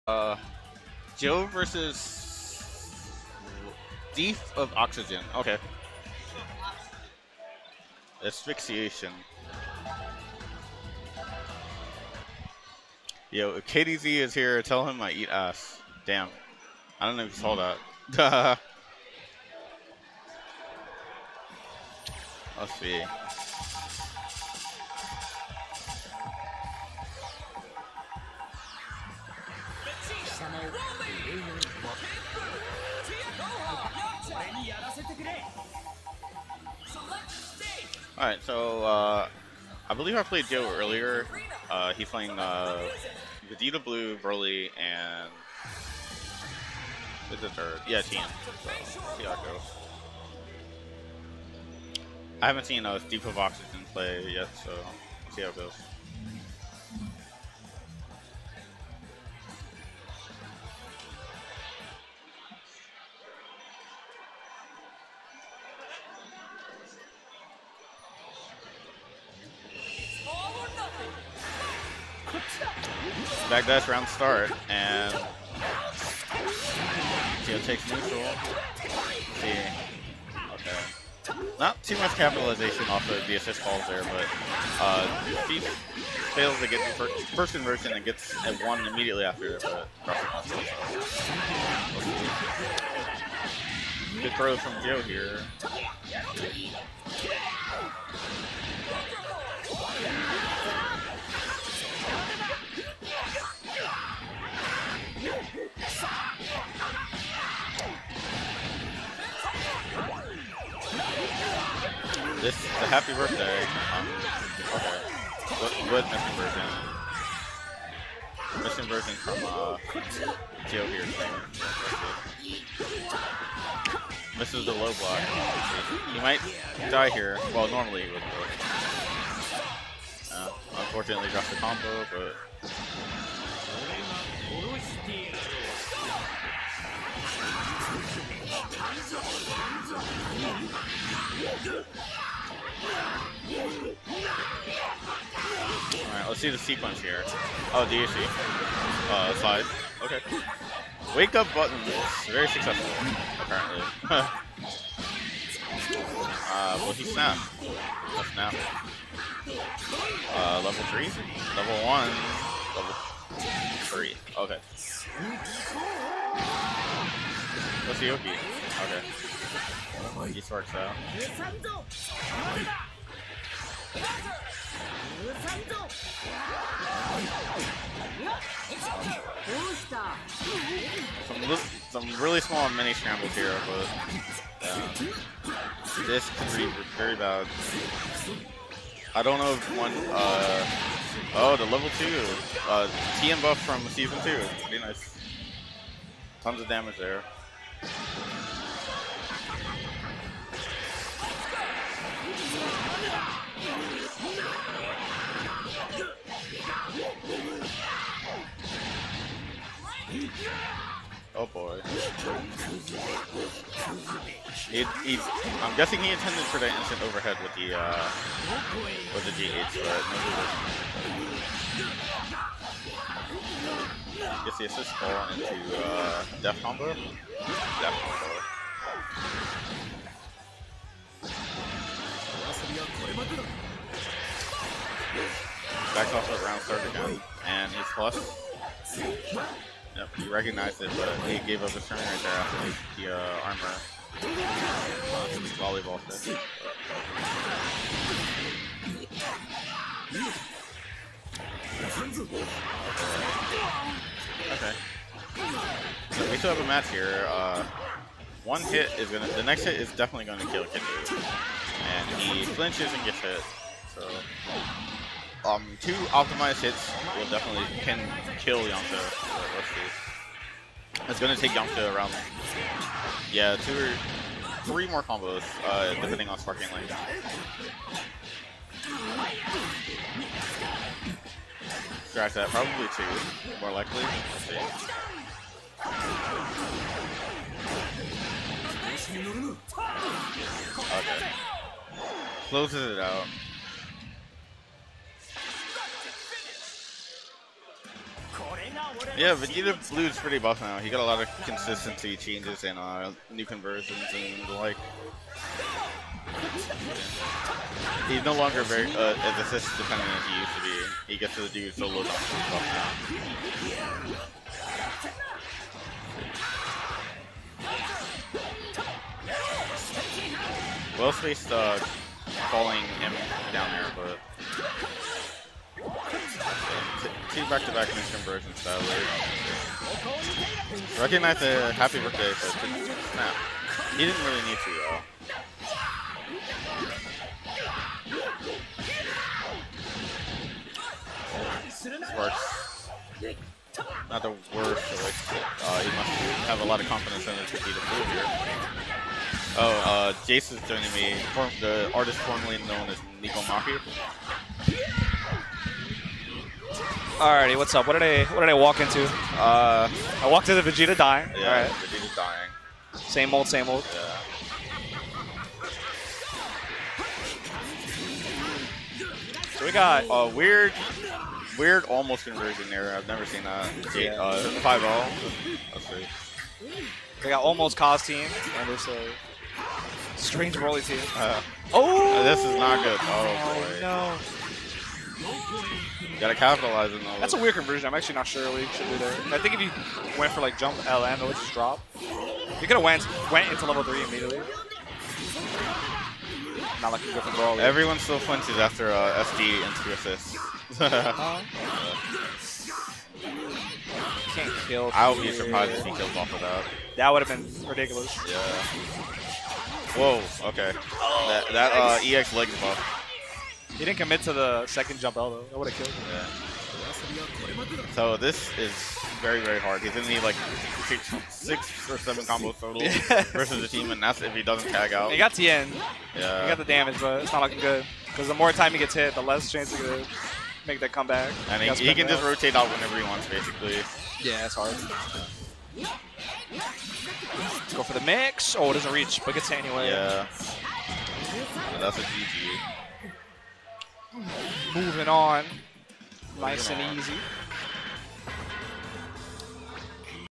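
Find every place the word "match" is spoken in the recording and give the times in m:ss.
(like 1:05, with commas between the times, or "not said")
4:16.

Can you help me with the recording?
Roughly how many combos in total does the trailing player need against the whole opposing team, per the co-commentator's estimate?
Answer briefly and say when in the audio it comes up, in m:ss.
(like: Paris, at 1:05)
six or seven, at 7:01.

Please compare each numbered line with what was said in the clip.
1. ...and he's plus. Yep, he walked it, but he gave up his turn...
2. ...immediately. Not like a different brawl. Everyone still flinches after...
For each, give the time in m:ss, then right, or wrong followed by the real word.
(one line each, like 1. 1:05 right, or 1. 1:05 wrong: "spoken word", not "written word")
1. 3:57 wrong: "recognized", not "walked"
2. 6:34 right.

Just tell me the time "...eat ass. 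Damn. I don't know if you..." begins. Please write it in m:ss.
0:15.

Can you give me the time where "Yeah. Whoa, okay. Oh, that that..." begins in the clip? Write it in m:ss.
6:48.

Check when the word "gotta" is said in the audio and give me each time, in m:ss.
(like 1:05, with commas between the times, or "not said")
6:26.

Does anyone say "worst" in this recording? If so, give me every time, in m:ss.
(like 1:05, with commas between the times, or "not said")
5:44.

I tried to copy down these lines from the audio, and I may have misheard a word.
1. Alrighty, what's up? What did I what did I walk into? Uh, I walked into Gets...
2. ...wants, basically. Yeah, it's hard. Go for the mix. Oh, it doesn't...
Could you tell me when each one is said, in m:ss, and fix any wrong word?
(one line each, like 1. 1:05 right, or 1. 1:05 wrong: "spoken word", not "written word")
1. 5:57 wrong: "Vegeta", not "Gets"
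2. 7:13 right.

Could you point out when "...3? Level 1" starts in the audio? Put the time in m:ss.
2:40.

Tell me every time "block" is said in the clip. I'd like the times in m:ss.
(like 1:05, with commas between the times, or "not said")
2:04.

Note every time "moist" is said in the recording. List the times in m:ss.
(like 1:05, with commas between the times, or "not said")
not said.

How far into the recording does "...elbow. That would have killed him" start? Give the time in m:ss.
6:55.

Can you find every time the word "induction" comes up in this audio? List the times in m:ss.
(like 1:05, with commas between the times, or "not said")
not said.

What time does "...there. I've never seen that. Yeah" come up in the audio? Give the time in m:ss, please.
6:12.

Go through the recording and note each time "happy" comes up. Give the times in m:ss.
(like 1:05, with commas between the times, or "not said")
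1:52, 5:31.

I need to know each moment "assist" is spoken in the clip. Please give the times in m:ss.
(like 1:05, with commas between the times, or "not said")
1:23, 3:44, 5:09, 6:39.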